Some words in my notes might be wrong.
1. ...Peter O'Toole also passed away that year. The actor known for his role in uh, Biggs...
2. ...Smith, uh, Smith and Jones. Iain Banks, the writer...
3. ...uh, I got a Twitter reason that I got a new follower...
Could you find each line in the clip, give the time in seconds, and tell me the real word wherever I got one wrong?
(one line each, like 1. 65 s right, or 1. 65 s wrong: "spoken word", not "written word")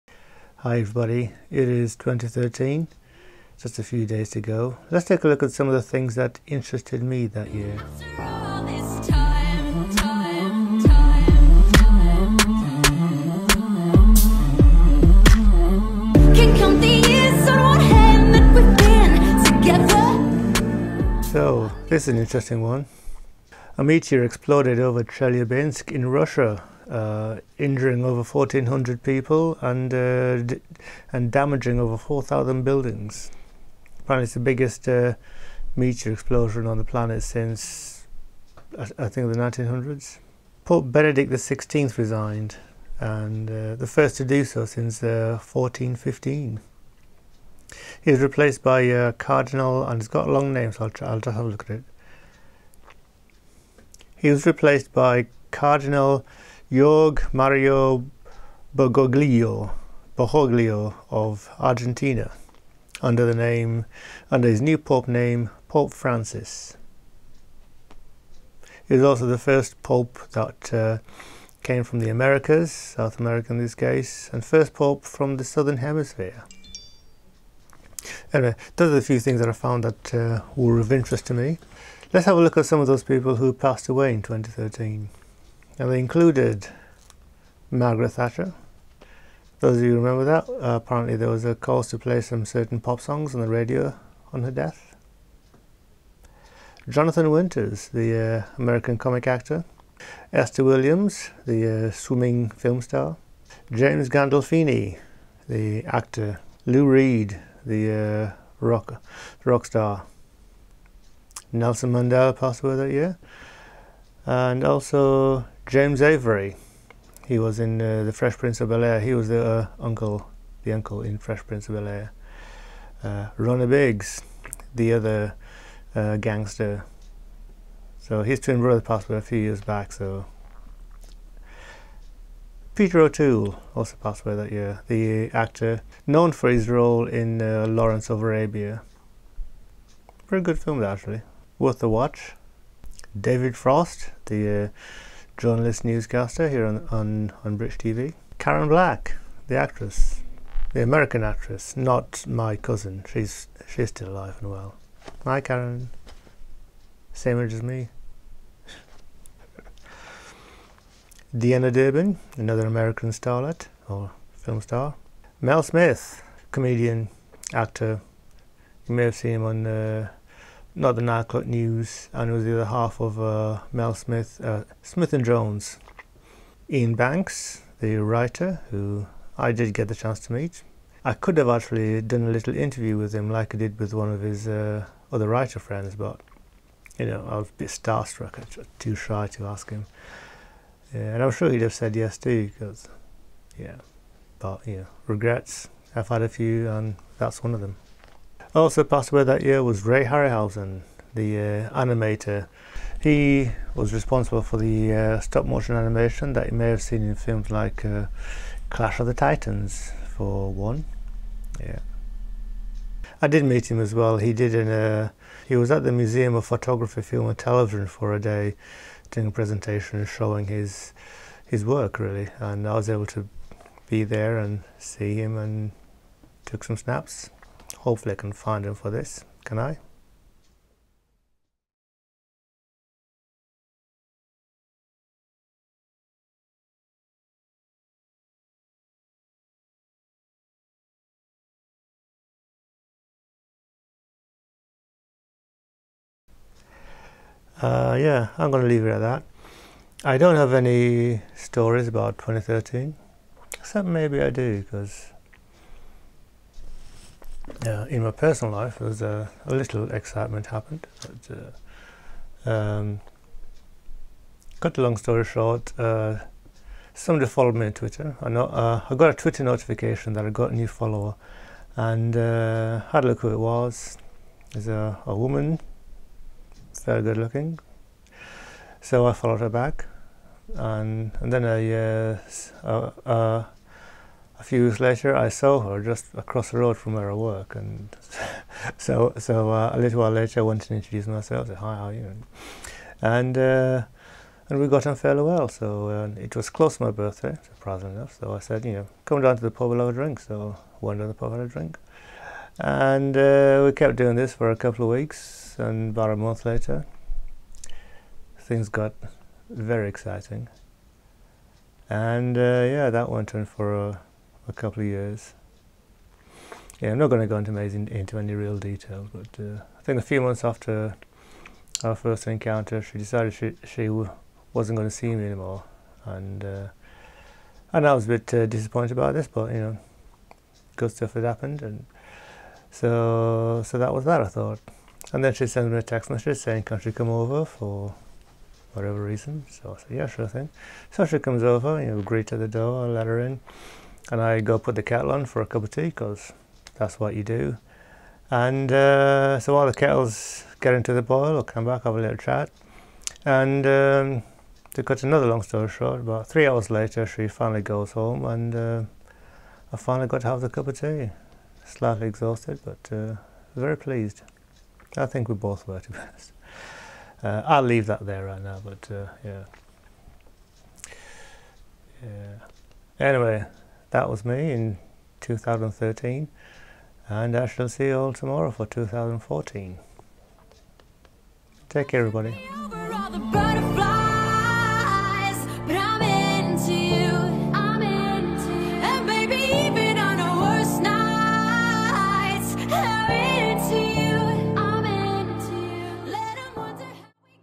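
1. 132 s wrong: "Lawrence", not "Biggs"
2. 173 s right
3. 268 s wrong: "notification", not "reason".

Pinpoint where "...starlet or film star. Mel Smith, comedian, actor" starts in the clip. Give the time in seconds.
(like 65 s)
163 s.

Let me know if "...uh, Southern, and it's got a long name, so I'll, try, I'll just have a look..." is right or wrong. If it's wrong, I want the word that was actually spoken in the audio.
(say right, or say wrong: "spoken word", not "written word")
wrong: "Cardinal", not "Southern".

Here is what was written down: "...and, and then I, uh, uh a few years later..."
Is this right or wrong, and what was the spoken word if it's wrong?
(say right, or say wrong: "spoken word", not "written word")
right.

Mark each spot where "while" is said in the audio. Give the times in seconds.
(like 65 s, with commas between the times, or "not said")
289 s, 349 s.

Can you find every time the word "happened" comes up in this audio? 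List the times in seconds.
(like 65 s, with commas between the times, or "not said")
260 s, 331 s.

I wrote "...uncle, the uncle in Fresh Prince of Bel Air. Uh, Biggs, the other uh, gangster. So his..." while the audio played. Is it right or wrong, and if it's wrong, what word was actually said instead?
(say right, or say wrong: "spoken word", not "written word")
right.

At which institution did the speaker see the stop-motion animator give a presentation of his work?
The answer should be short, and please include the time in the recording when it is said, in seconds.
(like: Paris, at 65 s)
Museum of Photography, Film and Television, at 215 s.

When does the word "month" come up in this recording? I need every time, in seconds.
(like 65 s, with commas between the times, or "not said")
306 s, 320 s.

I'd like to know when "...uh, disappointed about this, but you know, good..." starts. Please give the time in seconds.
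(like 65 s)
328 s.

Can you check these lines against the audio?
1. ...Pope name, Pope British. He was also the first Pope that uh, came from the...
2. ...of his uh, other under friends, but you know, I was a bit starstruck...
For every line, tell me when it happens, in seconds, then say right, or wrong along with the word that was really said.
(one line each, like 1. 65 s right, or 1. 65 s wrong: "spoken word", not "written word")
1. 64 s wrong: "Francis", not "British"
2. 184 s wrong: "writer", not "under".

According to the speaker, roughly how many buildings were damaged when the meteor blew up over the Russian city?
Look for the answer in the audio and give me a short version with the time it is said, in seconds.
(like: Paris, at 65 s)
over 4,000, at 31 s.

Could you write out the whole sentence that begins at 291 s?
Said, "Hi, how are you?" And uh, and we got on fairly well.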